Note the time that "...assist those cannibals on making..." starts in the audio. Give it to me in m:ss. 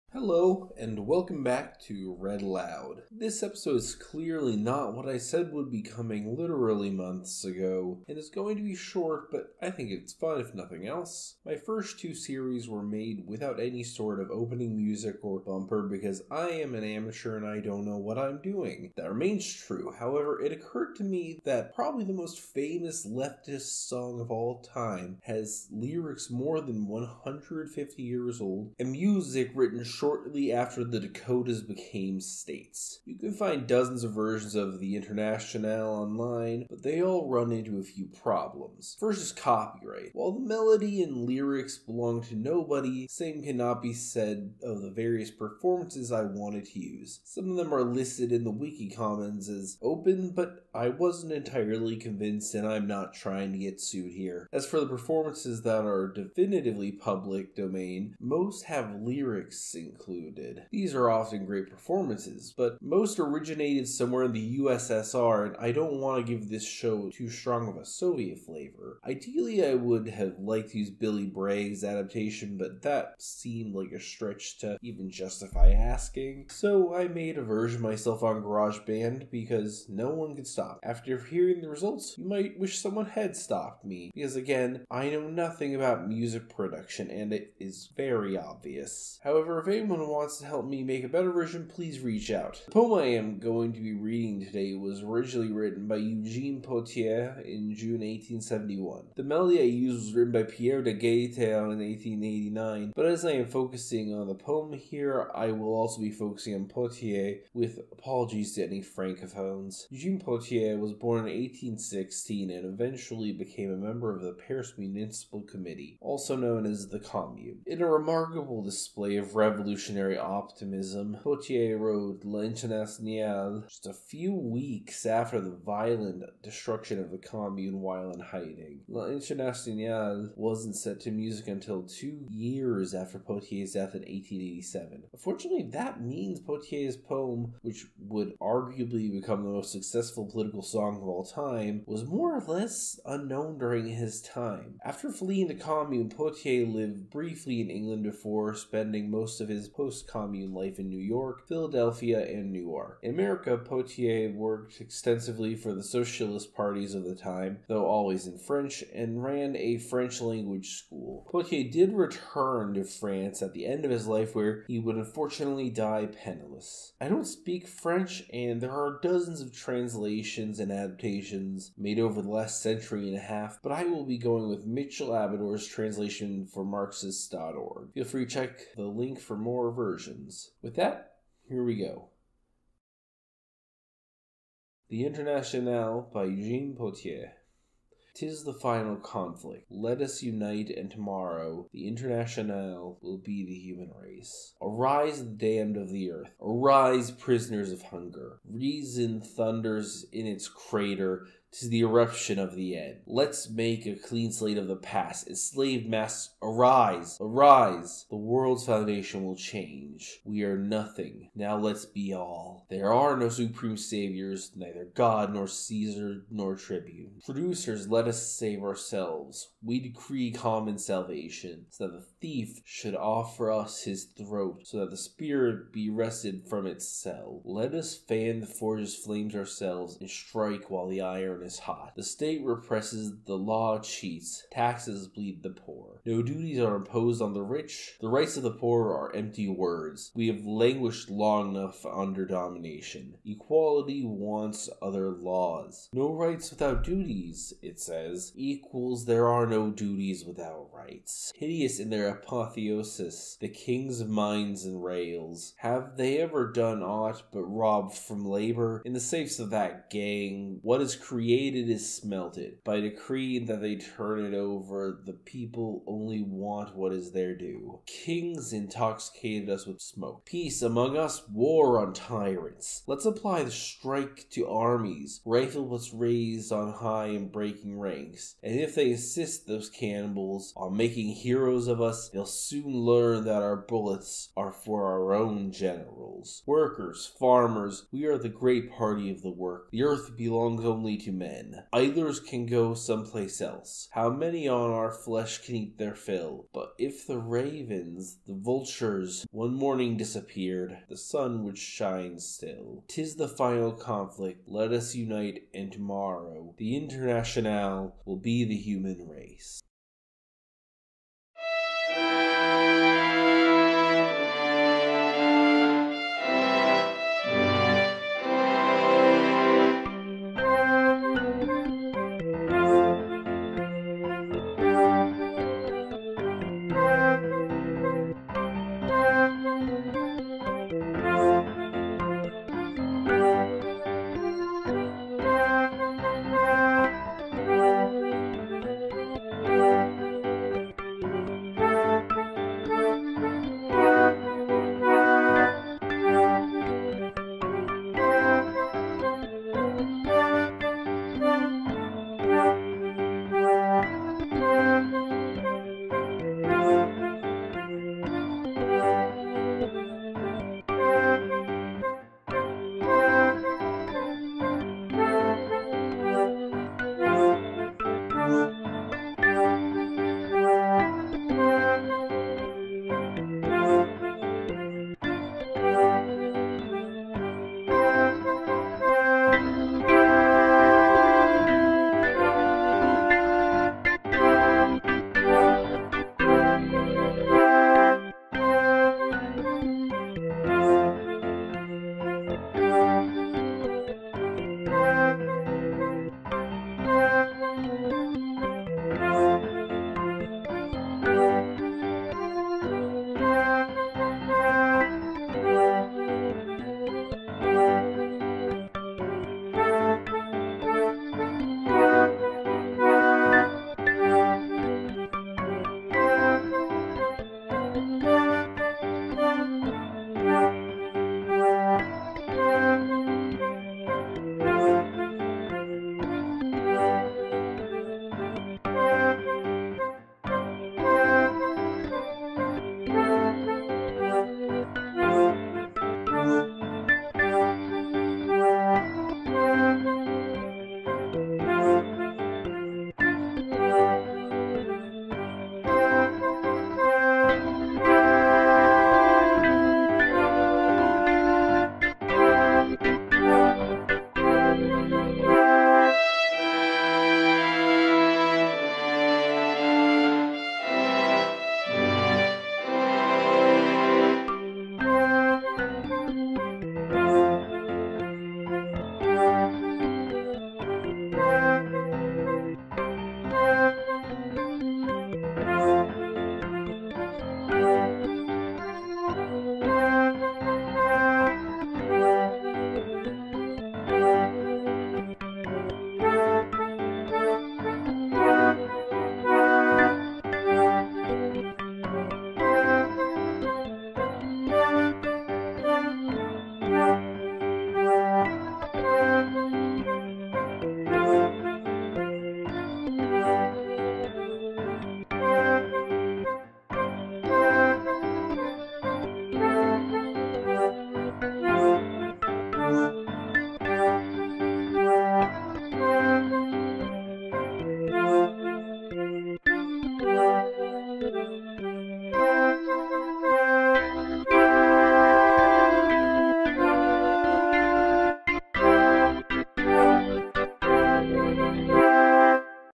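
4:38.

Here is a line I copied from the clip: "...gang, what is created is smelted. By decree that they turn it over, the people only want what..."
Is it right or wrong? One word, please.
right.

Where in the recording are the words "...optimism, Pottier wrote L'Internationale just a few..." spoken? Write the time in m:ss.
2:00.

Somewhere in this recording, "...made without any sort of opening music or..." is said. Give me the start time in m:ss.
0:12.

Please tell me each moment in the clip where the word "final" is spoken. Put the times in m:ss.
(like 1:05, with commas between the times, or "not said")
3:08, 5:03.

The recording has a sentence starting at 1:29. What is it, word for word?
However, if anyone anyone wants to help me make a better version, please reach out.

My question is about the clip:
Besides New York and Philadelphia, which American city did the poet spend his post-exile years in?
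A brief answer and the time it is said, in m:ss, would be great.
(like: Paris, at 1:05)
Newark, at 2:32.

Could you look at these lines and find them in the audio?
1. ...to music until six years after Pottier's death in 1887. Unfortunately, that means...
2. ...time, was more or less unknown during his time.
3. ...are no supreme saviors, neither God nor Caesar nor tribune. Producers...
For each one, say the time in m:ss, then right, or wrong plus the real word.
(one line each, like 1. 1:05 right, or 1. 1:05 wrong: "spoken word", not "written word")
1. 2:11 wrong: "two", not "six"
2. 2:21 right
3. 3:32 right.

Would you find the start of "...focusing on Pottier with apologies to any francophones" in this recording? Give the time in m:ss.
1:46.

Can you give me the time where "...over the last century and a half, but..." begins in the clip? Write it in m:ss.
2:51.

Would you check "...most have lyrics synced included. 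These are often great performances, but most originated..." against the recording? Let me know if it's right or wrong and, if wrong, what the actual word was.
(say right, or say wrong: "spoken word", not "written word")
right.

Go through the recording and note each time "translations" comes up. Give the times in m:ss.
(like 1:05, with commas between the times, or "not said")
2:49, 2:55.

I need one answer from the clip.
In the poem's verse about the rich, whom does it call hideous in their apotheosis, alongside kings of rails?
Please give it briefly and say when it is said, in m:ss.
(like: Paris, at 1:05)
kings of mines, at 4:13.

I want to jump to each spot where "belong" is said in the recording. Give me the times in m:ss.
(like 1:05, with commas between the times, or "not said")
0:41, 4:50.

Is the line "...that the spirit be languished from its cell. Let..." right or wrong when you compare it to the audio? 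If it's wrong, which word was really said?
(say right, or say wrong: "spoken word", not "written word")
wrong: "wrested", not "languished".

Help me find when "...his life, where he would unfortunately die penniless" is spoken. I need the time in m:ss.
2:43.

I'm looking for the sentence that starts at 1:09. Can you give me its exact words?
Ideally, I would have liked to use Billy Bragg's adaptation, but that seemed like a stretch to even justify asking.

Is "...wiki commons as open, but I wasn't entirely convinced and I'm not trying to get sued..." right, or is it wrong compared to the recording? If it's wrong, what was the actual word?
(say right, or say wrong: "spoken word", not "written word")
right.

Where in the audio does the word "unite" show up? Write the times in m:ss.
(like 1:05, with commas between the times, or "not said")
3:10, 5:04.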